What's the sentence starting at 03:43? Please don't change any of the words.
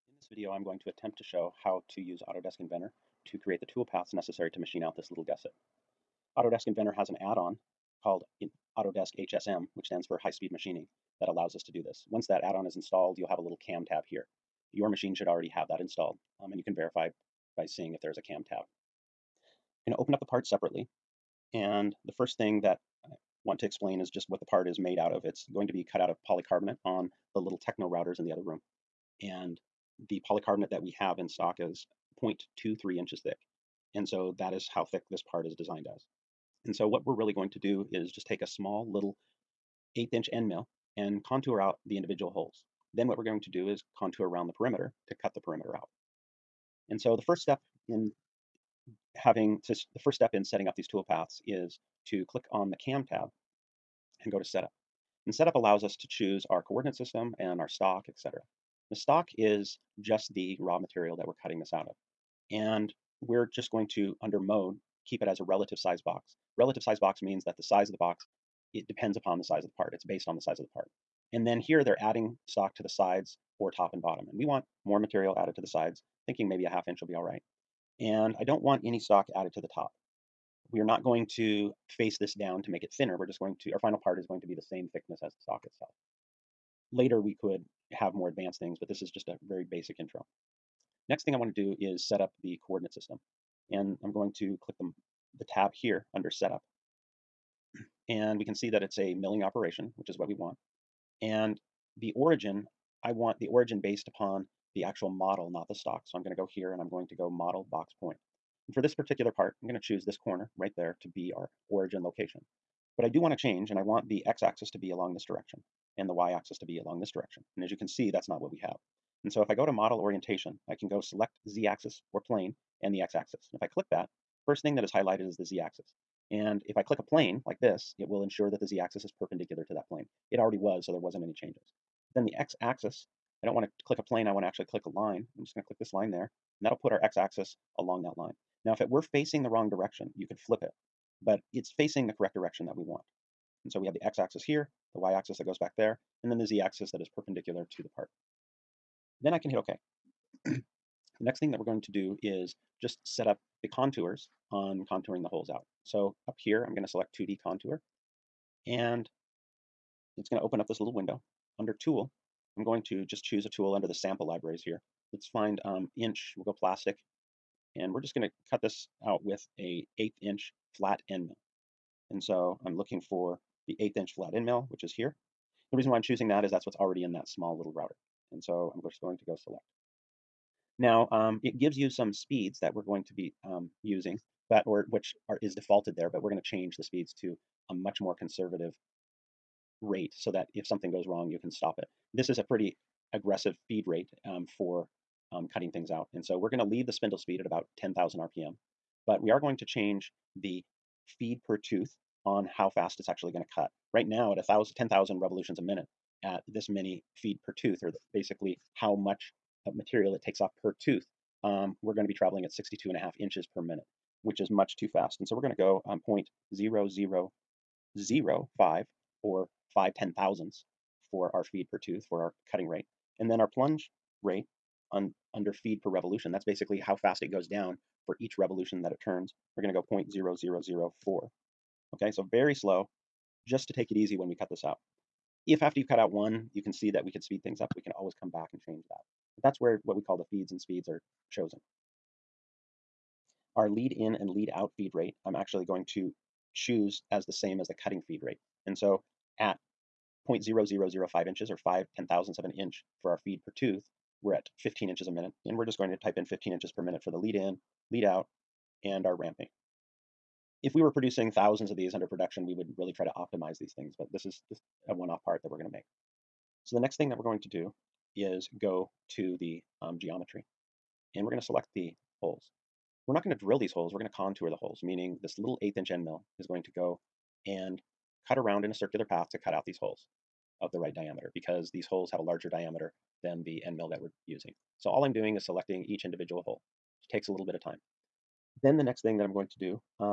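And then our plunge rate on under feed per revolution.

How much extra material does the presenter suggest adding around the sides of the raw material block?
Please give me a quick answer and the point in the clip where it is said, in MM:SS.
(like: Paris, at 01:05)
a half inch, at 01:16.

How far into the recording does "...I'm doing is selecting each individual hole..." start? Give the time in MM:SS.
04:45.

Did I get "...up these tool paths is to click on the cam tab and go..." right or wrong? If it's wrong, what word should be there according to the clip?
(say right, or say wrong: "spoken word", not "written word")
right.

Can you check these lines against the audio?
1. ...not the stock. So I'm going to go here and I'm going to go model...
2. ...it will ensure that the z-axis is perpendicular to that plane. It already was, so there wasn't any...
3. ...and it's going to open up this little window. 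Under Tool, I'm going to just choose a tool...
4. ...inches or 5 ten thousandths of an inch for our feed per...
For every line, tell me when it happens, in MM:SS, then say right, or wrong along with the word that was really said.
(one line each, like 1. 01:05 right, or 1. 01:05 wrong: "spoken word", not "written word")
1. 01:45 right
2. 02:07 right
3. 02:38 right
4. 04:11 right.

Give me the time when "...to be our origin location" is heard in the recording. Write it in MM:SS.
01:51.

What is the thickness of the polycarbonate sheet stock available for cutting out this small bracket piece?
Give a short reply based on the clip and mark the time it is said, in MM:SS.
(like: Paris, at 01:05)
0.23 inches, at 00:32.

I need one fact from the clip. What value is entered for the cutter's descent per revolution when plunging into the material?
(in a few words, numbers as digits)
0.0004.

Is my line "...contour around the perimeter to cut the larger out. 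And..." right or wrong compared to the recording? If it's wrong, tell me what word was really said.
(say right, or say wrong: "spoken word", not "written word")
wrong: "perimeter", not "larger".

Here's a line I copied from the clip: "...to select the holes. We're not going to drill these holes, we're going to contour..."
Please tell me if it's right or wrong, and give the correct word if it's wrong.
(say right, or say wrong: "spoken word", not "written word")
right.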